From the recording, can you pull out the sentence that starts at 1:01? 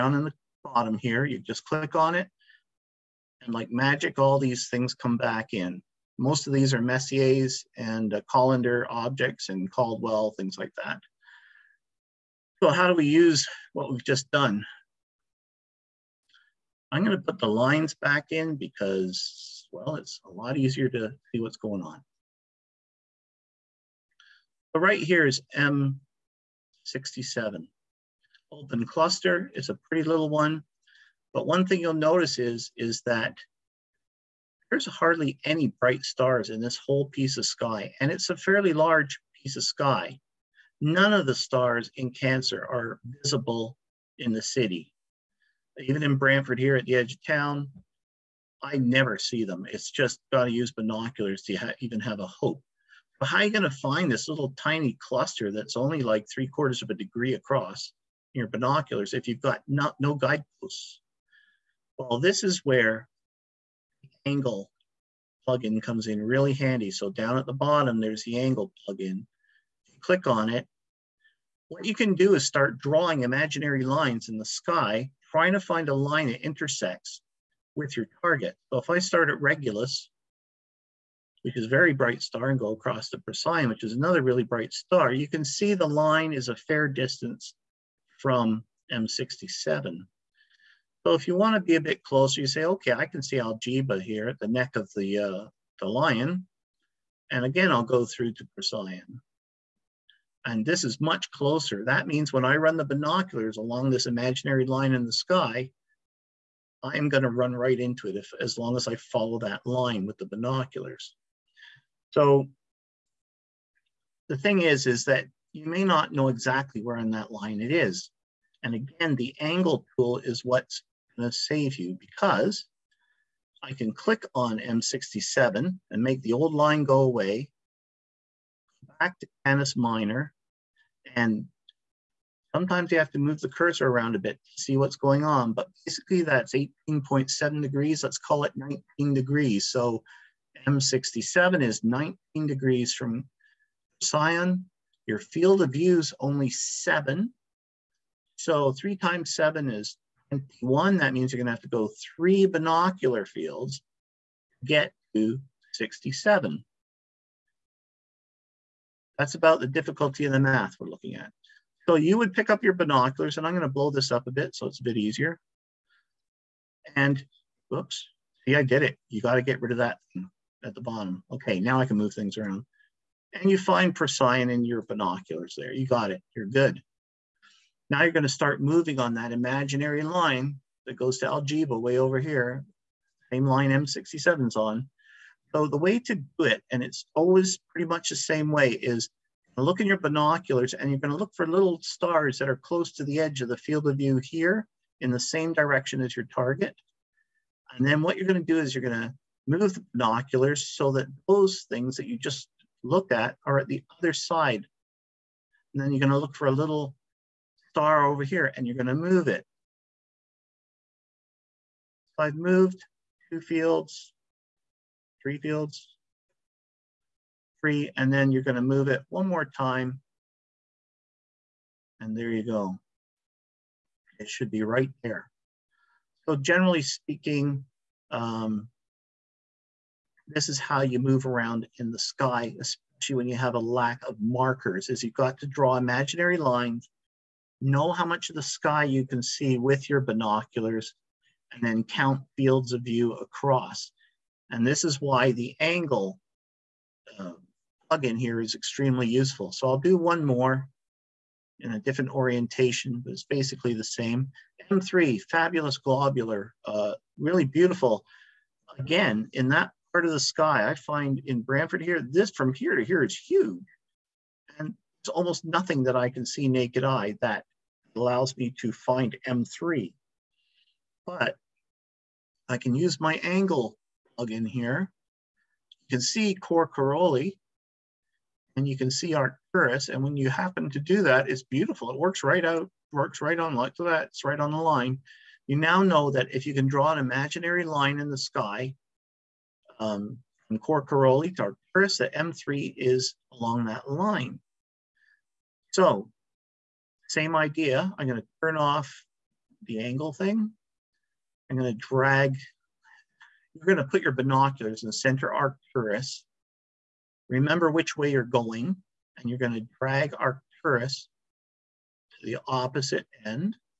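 Well, this is where the angle plugin comes in really handy.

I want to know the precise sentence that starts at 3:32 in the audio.
So I've moved two fields, three fields, three, and then you're going to move it one more time.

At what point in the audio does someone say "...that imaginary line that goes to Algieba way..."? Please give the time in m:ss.
2:59.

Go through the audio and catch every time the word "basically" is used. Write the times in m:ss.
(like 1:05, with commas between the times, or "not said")
2:15, 4:13.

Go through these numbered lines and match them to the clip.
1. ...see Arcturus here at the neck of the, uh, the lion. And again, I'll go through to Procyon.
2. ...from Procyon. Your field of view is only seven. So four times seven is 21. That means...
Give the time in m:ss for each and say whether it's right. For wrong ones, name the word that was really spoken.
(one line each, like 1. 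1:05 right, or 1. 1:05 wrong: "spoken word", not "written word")
1. 1:33 wrong: "Algieba", not "Arcturus"
2. 2:22 wrong: "three", not "four".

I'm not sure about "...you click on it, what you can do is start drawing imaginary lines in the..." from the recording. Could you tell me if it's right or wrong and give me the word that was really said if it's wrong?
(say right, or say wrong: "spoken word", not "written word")
right.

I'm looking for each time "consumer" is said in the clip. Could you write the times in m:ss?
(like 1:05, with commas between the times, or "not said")
not said.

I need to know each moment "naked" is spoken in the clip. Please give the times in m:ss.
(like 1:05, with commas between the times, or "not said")
4:26.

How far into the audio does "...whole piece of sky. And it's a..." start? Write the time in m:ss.
0:36.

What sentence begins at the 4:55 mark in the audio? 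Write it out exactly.
So same idea, I'm gonna turn off the angle thing.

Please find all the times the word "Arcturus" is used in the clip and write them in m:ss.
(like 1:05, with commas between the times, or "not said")
4:39, 4:51, 5:05, 5:10.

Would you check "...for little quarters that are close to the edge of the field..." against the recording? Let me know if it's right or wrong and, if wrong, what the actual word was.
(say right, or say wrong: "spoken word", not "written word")
wrong: "stars", not "quarters".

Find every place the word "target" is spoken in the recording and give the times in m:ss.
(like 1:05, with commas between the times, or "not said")
1:18, 3:16.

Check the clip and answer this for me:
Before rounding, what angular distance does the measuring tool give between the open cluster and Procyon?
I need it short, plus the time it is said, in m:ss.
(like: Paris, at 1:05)
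18.7 degrees, at 2:16.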